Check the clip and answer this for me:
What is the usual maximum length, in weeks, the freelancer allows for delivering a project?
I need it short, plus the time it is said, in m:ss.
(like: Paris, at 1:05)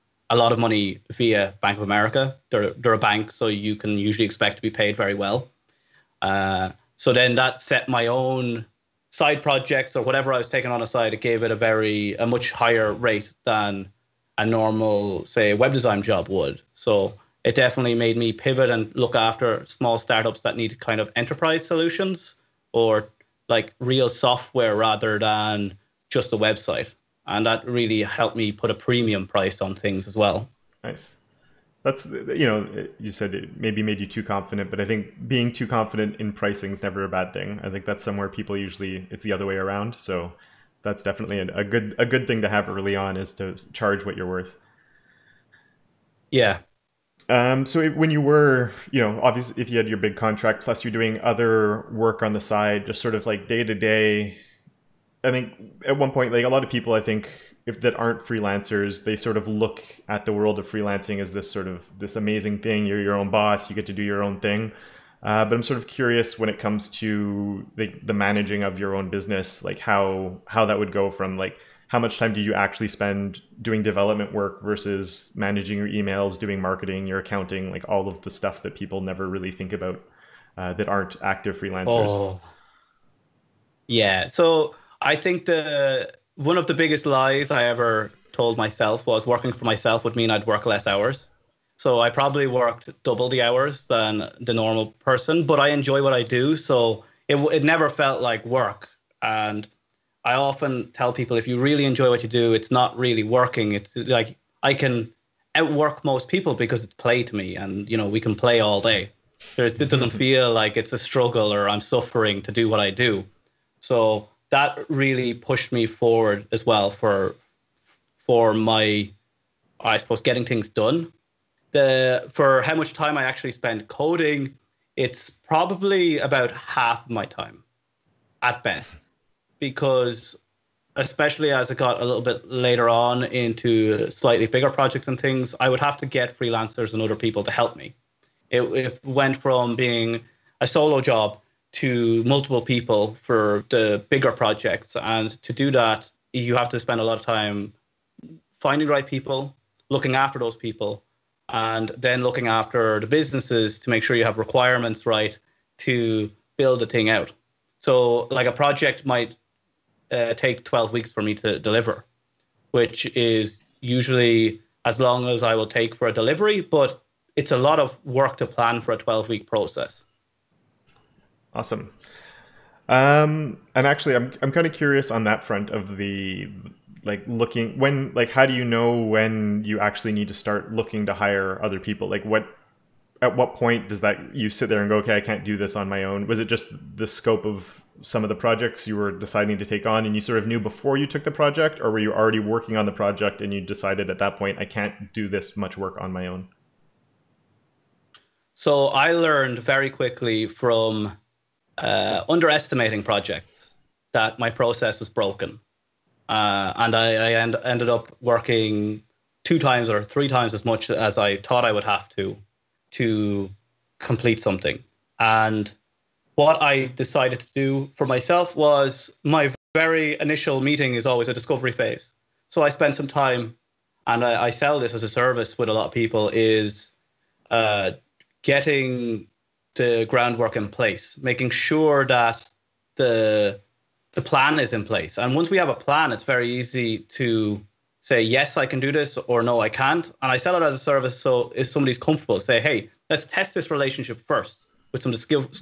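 12 weeks, at 2:40.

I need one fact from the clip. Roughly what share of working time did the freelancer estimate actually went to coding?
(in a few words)
half.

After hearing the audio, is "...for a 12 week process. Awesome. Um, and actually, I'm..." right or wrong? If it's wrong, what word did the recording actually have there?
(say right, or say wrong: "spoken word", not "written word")
right.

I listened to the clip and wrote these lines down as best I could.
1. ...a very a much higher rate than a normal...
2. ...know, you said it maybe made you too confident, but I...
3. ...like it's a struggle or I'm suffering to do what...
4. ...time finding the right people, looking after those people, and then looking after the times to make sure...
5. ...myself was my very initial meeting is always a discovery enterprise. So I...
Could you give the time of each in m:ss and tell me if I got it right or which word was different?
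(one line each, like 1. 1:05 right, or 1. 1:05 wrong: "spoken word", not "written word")
1. 0:11 right
2. 0:32 right
3. 1:50 right
4. 2:27 wrong: "businesses", not "times"
5. 3:38 wrong: "phase", not "enterprise".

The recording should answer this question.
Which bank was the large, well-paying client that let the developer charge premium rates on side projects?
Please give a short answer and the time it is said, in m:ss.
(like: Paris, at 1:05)
Bank of America, at 0:01.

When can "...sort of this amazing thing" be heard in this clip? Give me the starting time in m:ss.
1:01.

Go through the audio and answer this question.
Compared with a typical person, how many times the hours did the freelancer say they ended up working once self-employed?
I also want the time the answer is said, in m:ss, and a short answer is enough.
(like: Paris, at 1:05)
double, at 1:33.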